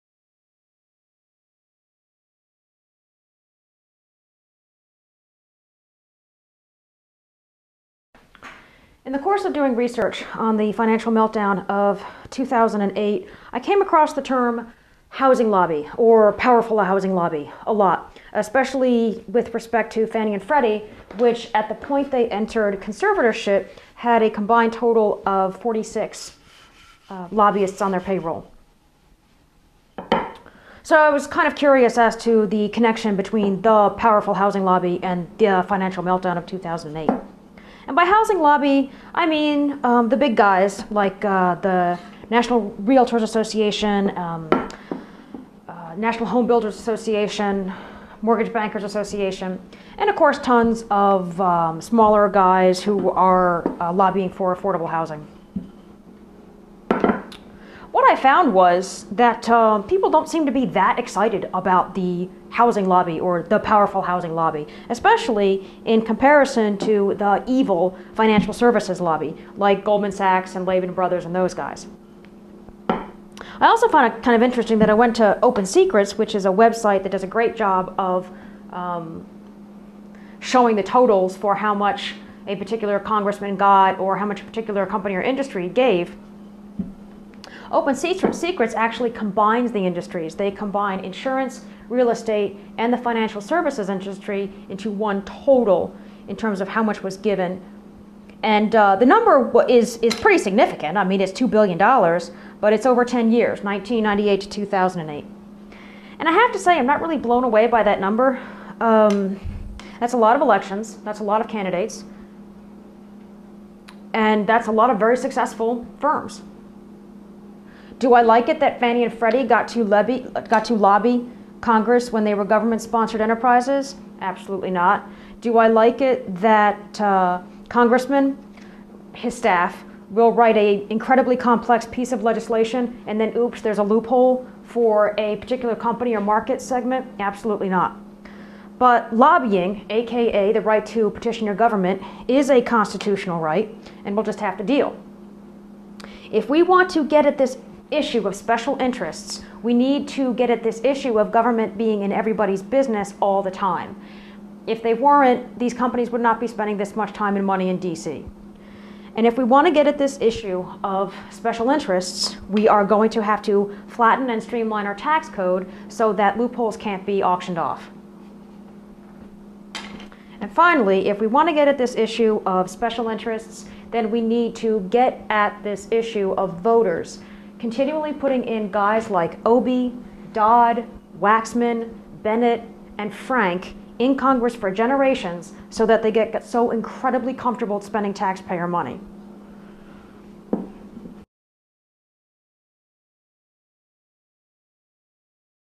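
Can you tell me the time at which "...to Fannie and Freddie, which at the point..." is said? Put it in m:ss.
0:19.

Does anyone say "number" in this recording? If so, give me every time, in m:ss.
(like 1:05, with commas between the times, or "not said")
1:39, 1:48.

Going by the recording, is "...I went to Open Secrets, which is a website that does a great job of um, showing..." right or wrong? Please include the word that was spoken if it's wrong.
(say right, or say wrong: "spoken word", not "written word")
right.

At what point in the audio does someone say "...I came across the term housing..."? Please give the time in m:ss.
0:13.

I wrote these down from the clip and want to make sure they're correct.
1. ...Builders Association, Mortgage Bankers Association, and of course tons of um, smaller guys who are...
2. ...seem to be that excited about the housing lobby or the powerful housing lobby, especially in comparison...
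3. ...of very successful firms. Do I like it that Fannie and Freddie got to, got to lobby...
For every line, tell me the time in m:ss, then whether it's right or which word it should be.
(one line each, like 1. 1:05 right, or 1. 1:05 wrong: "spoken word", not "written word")
1. 0:46 right
2. 1:00 right
3. 1:54 right.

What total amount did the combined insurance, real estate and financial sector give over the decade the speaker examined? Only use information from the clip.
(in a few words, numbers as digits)
$2 billion.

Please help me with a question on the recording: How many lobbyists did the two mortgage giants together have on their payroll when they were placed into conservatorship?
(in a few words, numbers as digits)
46.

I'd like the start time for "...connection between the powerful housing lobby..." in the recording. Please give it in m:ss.
0:32.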